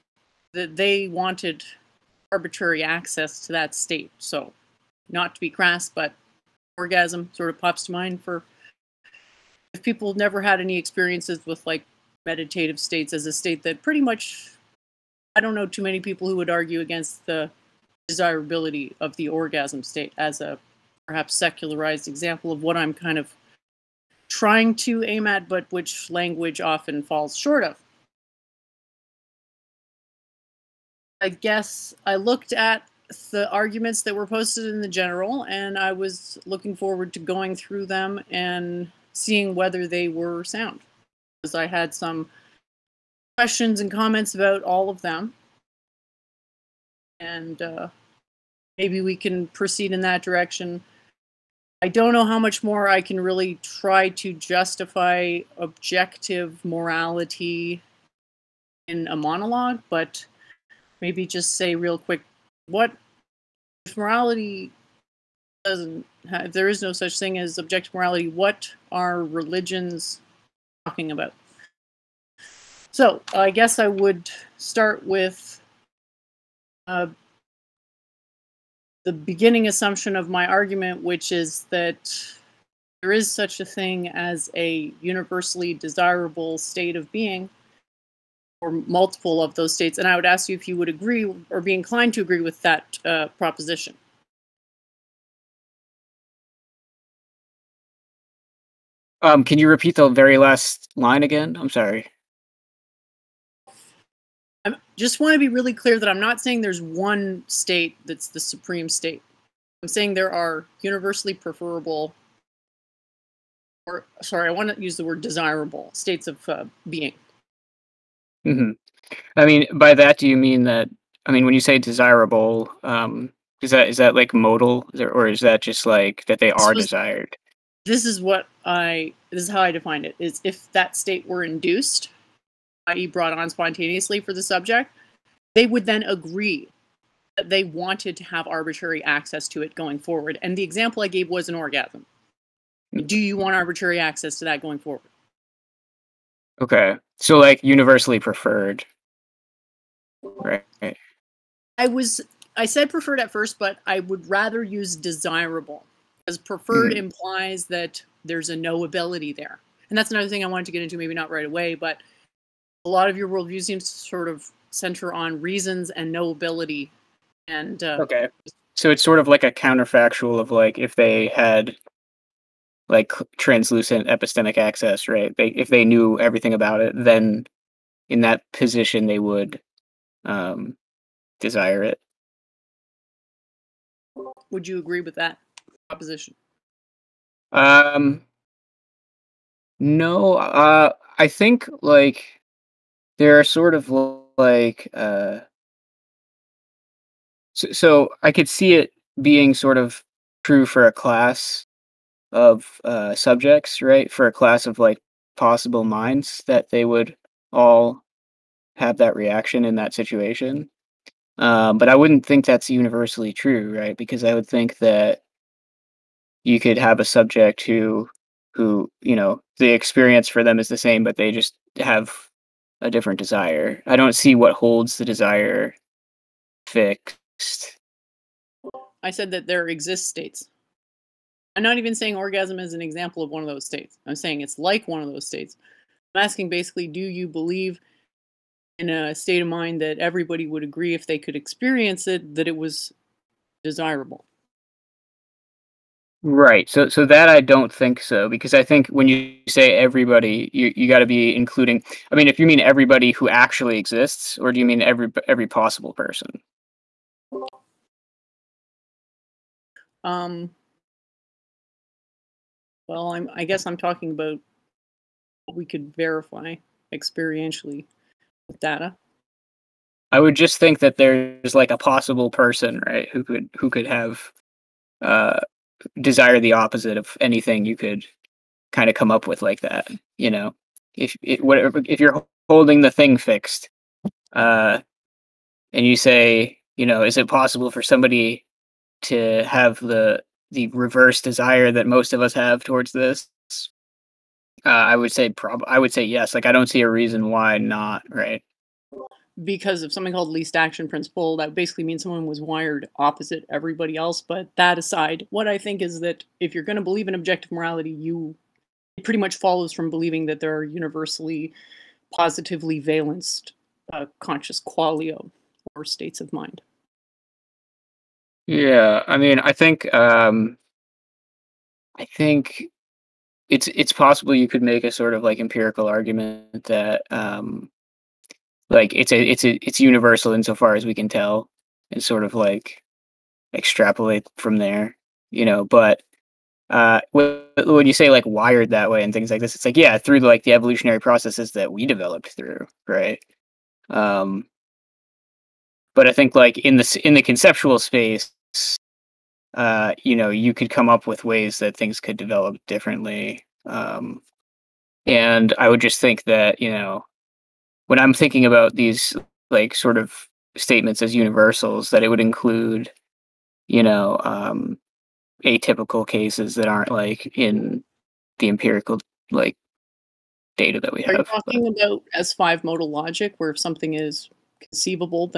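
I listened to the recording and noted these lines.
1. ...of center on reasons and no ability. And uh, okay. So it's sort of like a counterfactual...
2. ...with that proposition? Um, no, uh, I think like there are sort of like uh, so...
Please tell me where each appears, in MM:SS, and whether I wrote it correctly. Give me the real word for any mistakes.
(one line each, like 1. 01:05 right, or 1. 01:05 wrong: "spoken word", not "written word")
1. 02:44 right
2. 03:04 right.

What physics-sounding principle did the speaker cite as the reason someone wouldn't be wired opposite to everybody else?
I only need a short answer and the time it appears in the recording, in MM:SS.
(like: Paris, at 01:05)
least action principle, at 05:00.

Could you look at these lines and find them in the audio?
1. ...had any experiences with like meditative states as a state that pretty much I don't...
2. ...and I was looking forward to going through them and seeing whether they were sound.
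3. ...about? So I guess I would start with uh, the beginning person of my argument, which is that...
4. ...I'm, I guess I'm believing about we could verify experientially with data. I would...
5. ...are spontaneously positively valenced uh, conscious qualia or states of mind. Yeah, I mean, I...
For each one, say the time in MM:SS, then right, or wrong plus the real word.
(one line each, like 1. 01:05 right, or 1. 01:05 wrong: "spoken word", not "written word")
1. 00:10 right
2. 00:35 right
3. 01:11 wrong: "assumption", not "person"
4. 04:23 wrong: "talking", not "believing"
5. 05:10 wrong: "universally", not "spontaneously".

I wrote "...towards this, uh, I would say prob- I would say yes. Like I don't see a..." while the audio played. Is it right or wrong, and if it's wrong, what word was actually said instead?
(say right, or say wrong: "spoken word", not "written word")
right.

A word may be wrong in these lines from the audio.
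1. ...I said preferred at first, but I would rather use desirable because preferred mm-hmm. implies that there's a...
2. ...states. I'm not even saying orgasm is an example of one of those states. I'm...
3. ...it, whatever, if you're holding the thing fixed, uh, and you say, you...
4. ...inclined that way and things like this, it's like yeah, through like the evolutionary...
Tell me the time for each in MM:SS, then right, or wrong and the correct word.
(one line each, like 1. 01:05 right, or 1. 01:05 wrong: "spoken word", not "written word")
1. 02:32 right
2. 03:50 right
3. 04:41 right
4. 05:38 wrong: "wired", not "inclined".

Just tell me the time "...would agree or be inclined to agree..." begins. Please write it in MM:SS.
01:30.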